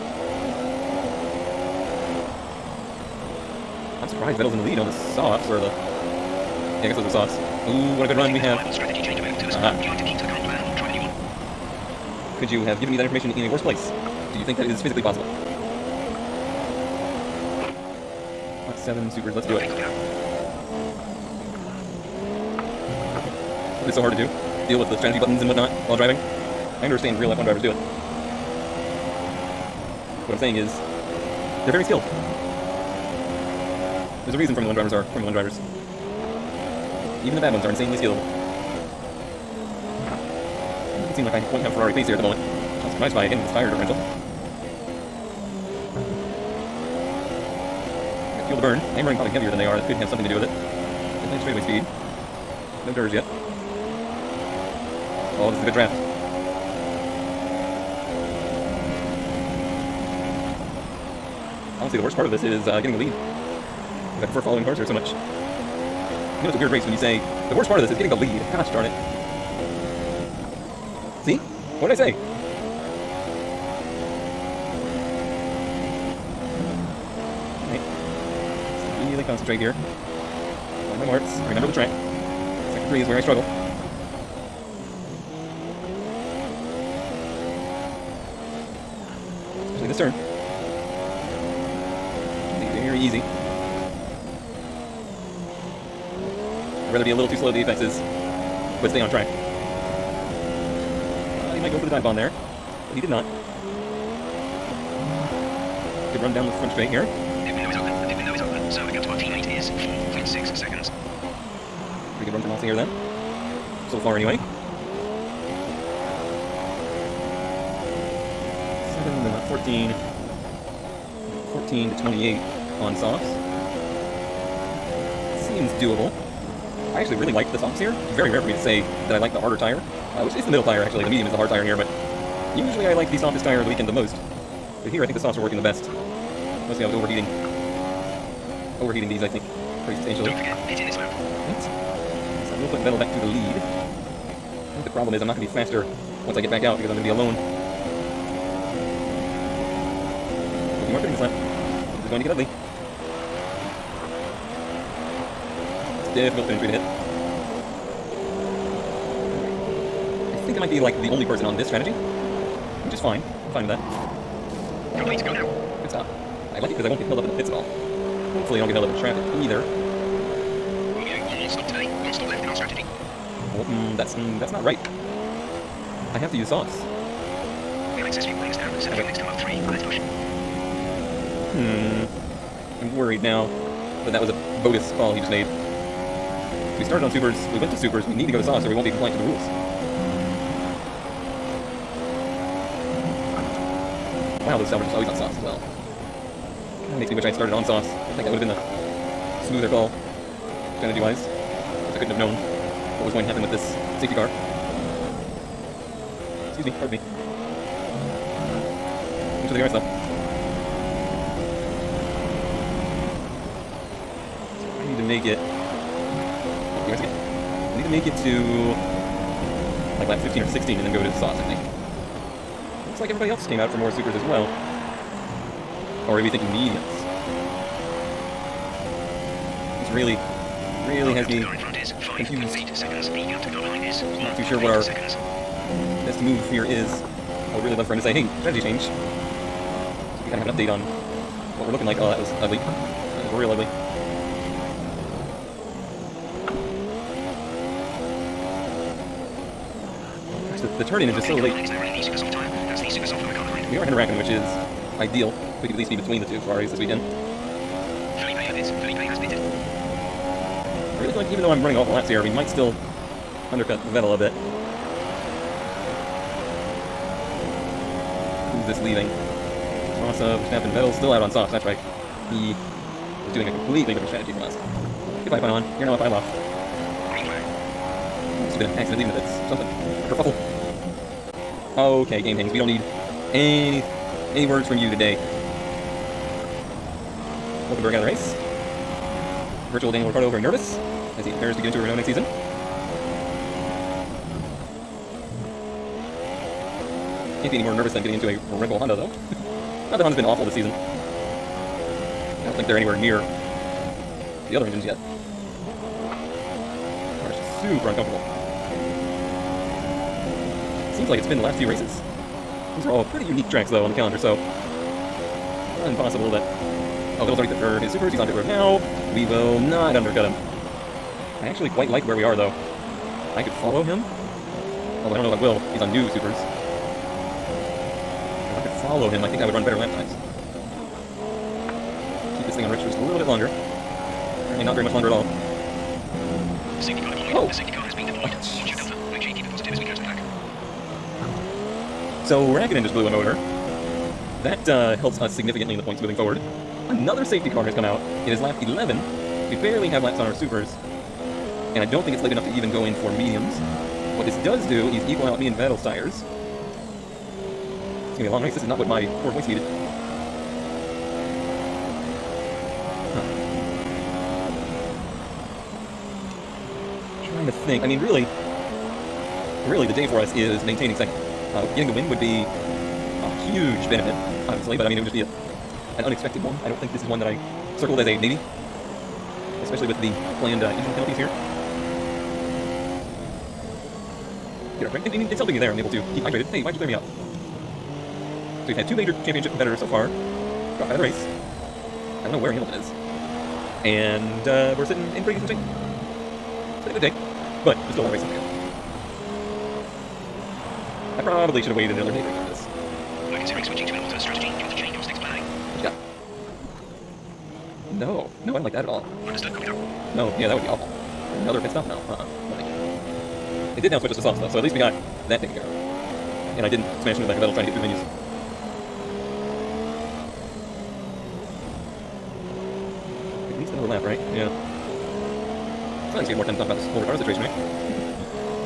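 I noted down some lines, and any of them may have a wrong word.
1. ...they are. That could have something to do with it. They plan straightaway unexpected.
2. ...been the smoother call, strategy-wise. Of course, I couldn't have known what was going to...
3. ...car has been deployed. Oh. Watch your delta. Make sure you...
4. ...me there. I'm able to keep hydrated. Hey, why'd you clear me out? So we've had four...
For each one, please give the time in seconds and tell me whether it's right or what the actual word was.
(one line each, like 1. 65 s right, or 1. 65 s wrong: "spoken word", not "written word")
1. 49 s wrong: "speed", not "unexpected"
2. 198 s right
3. 337 s right
4. 385 s wrong: "two", not "four".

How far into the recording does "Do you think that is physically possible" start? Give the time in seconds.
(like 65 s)
14 s.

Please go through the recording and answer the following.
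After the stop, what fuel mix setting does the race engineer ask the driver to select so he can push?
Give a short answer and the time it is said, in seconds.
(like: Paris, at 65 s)
mode 3, at 179 s.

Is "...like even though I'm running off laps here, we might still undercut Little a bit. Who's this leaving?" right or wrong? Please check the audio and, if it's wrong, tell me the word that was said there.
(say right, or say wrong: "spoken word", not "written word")
wrong: "Vettel", not "Little".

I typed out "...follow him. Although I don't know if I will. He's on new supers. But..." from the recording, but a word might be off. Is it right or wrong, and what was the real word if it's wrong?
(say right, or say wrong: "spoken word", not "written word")
right.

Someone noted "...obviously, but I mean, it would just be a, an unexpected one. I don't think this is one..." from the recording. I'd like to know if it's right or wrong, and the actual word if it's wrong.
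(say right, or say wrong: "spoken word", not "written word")
right.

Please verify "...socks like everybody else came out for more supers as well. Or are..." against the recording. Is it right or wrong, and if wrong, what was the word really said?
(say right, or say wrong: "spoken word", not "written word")
wrong: "looks", not "socks".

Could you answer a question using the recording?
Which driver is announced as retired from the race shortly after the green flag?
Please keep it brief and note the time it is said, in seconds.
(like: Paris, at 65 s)
Hulkenberg, at 287 s.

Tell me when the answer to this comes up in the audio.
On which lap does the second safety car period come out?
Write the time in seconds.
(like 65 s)
348 s.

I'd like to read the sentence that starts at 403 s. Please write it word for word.
We're considering switching to an alternate strategy.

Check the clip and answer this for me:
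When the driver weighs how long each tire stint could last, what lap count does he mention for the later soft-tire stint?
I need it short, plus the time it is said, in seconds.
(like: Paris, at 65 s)
28, at 121 s.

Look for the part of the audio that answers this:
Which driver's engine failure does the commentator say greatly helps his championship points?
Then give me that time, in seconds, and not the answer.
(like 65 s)
342 s.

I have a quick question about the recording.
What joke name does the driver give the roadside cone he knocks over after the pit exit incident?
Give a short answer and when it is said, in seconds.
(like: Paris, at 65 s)
Pylop, at 275 s.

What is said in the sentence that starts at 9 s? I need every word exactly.
Would you like to keep to the current plan or try the new one?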